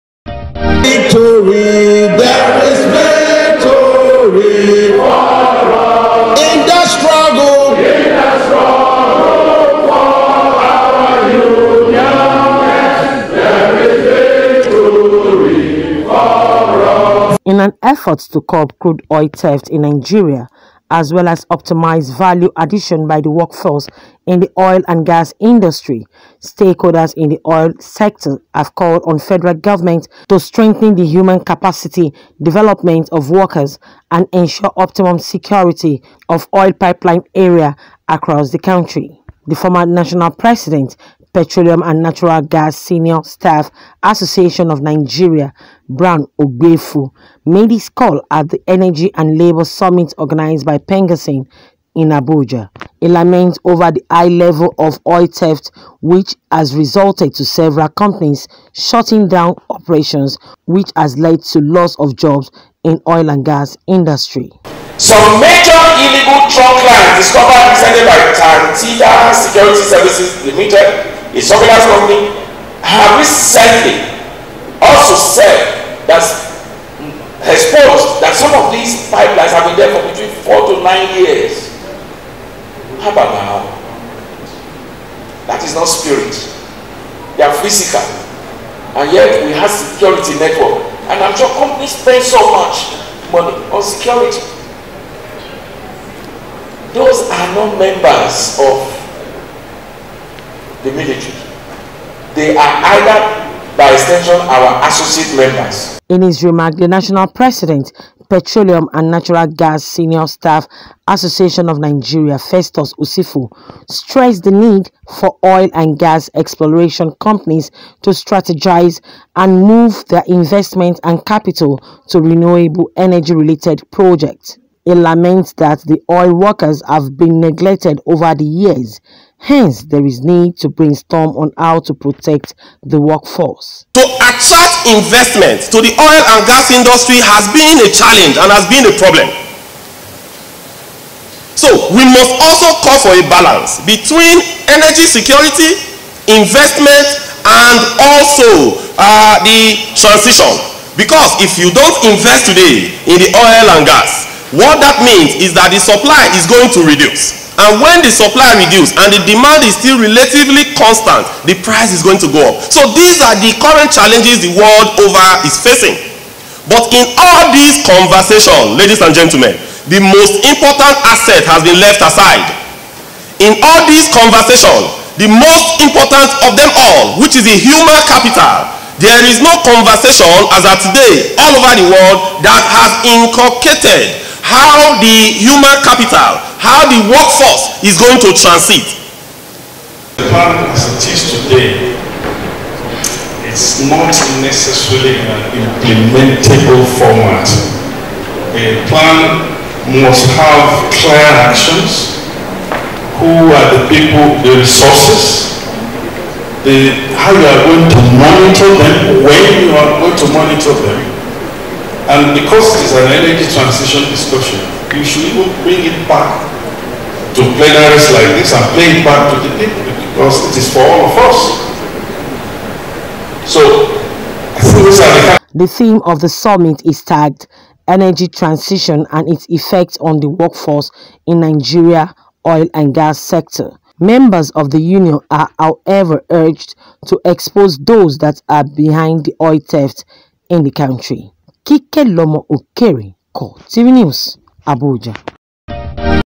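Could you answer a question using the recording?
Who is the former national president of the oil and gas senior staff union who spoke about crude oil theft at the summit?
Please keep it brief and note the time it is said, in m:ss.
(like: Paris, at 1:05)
Brown Ogbeifun, at 0:45.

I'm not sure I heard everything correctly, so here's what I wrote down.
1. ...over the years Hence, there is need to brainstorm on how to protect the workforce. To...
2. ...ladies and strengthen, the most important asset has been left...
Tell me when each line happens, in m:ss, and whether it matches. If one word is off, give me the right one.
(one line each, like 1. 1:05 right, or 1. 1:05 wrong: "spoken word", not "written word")
1. 2:08 right
2. 2:48 wrong: "gentlemen", not "strengthen".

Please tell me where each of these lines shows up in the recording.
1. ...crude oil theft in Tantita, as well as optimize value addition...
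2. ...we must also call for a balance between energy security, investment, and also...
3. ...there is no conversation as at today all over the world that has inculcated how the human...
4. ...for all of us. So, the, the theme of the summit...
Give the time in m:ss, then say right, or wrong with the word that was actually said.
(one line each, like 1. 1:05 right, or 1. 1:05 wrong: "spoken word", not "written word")
1. 0:18 wrong: "Nigeria", not "Tantita"
2. 2:21 right
3. 2:58 right
4. 3:40 right.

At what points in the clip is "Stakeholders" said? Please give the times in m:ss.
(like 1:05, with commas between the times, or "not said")
0:26.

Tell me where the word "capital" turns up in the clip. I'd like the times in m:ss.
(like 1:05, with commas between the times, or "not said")
2:01, 2:58, 3:05.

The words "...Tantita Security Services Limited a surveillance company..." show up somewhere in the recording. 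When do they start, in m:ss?
1:08.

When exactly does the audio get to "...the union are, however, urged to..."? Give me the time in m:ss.
3:54.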